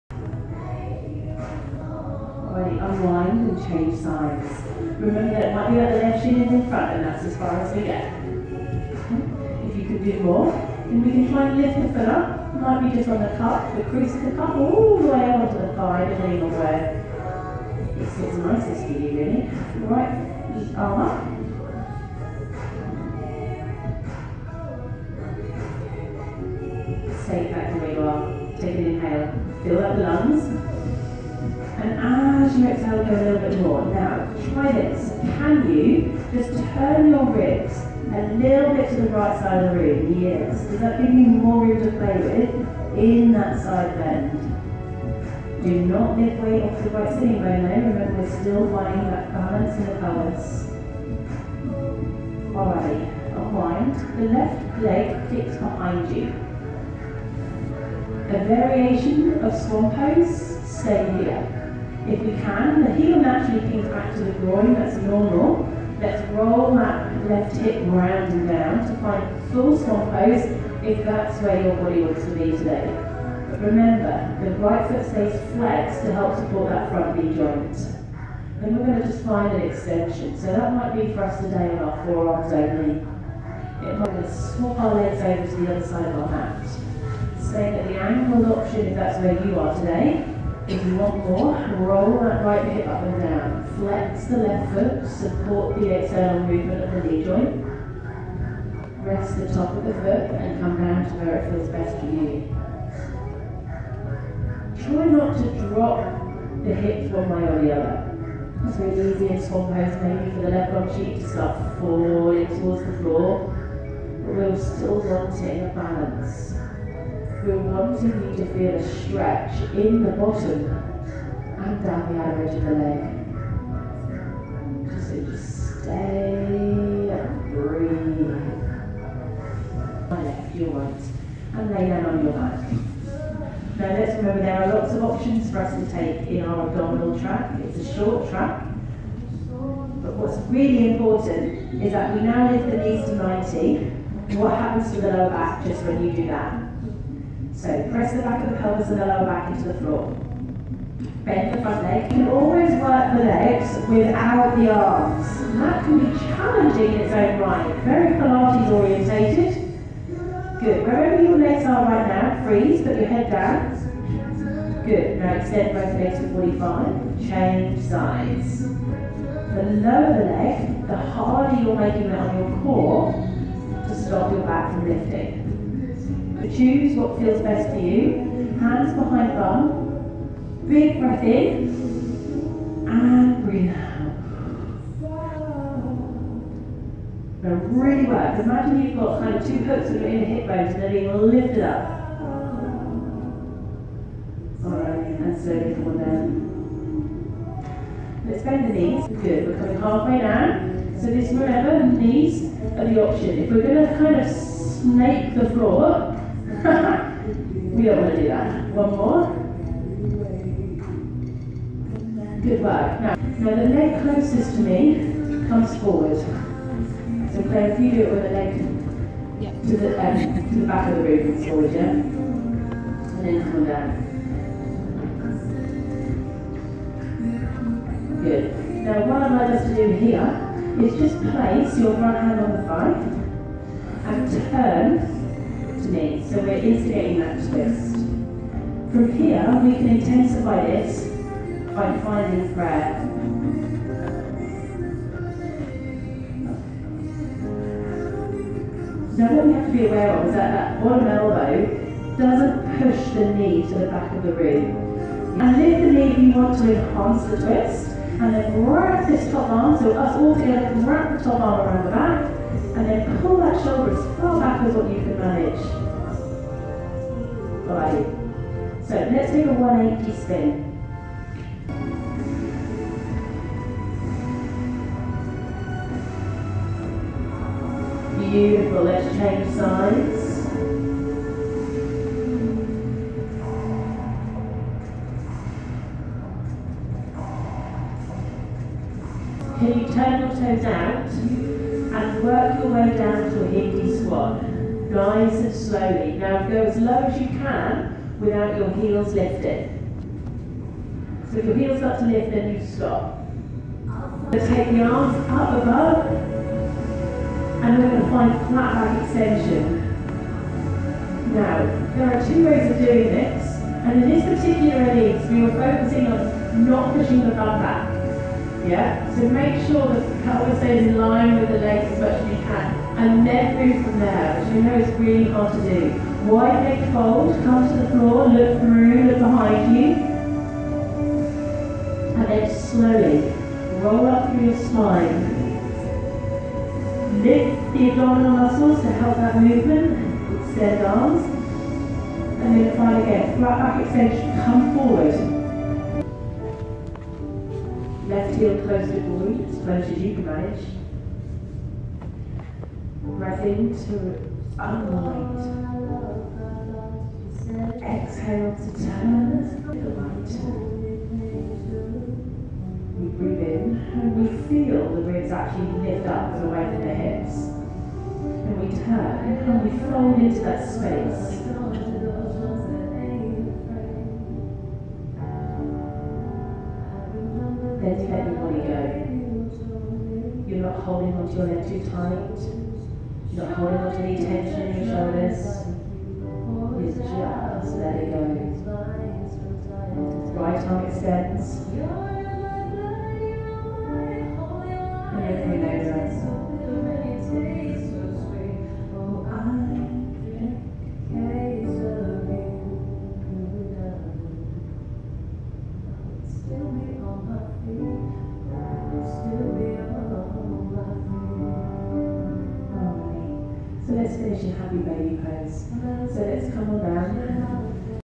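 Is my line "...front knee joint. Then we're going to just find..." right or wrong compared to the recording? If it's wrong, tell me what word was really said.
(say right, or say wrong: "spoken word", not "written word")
right.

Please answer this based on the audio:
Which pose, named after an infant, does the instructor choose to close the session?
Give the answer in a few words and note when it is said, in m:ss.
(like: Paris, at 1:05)
happy baby pose, at 6:54.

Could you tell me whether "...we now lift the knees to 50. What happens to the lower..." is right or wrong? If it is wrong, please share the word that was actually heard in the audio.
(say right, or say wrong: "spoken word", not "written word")
wrong: "90", not "50".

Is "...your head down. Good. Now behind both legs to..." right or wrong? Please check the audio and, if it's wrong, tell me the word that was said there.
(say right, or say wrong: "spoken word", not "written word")
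wrong: "extend", not "behind".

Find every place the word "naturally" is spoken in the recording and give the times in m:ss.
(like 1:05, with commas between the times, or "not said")
1:03.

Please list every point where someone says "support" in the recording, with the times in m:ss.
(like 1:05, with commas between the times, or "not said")
1:16, 1:35.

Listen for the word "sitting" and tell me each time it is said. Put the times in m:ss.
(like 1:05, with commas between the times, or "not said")
0:47.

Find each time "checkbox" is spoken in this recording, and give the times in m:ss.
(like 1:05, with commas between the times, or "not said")
not said.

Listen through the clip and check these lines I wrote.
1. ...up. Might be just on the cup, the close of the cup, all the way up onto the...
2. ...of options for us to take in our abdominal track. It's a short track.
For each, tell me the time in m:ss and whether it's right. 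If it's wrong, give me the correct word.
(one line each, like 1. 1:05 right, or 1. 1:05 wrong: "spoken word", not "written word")
1. 0:12 wrong: "crease", not "close"
2. 2:14 right.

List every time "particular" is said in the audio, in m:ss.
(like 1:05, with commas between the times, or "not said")
5:14.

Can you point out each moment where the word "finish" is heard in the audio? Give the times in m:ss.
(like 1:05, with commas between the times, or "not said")
6:54.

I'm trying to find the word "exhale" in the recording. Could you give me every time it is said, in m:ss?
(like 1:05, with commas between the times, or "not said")
0:32, 5:57.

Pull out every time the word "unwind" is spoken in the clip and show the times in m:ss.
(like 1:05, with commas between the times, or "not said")
0:02, 0:53, 5:54.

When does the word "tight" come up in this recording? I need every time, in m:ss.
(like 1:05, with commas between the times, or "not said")
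6:21.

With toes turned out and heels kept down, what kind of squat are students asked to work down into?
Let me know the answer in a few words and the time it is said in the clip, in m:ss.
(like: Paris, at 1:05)
Hindi squat, at 4:53.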